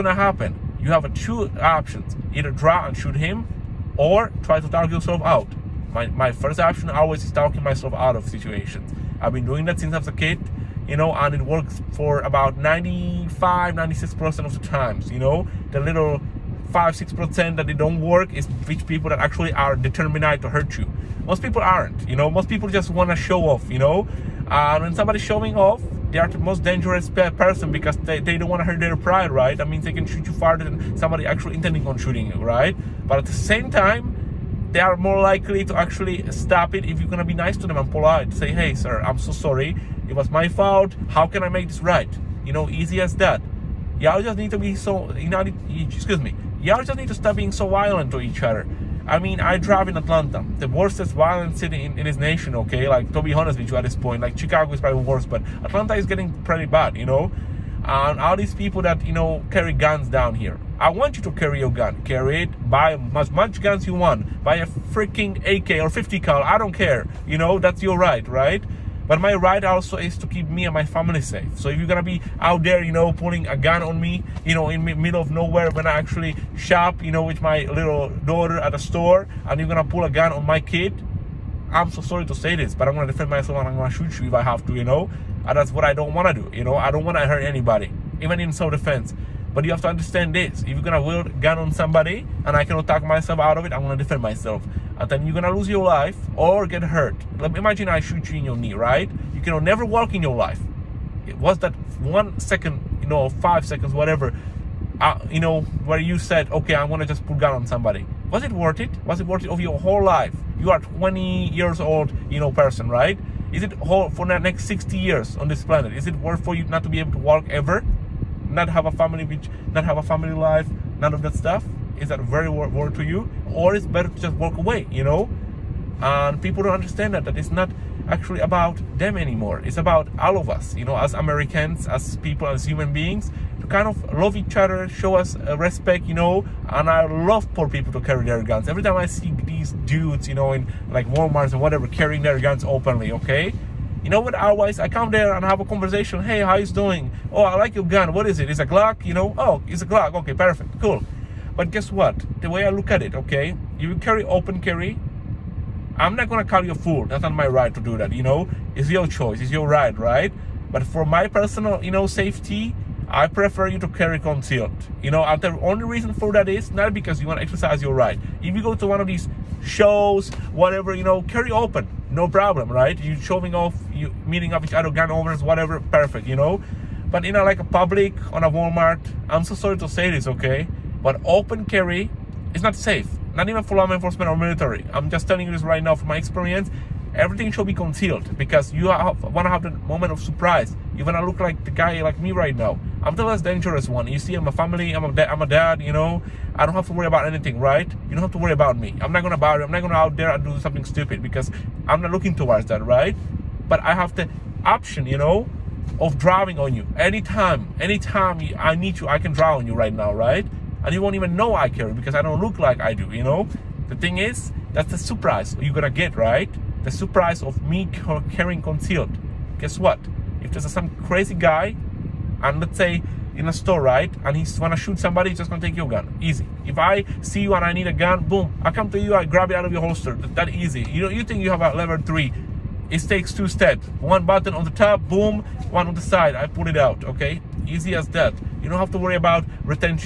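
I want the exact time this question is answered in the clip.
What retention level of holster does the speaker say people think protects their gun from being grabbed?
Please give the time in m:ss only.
3:51.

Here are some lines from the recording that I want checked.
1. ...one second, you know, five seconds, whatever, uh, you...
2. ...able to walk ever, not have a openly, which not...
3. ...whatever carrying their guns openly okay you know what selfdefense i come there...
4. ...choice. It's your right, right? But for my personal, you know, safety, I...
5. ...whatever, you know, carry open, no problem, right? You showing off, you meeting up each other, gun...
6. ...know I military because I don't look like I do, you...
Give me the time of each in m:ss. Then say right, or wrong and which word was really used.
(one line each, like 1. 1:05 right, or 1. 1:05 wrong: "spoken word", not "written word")
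1. 1:42 right
2. 1:56 wrong: "family", not "openly"
3. 2:21 wrong: "otherwise", not "selfdefense"
4. 2:39 right
5. 2:50 right
6. 3:31 wrong: "carry", not "military".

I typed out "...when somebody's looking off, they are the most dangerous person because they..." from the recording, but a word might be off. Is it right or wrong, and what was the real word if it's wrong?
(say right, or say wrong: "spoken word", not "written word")
wrong: "showing", not "looking".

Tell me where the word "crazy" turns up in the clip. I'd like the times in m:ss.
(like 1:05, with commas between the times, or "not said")
3:41.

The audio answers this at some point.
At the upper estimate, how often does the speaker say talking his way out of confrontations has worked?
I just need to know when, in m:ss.
0:13.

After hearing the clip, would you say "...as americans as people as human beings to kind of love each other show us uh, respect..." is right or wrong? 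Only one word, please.
right.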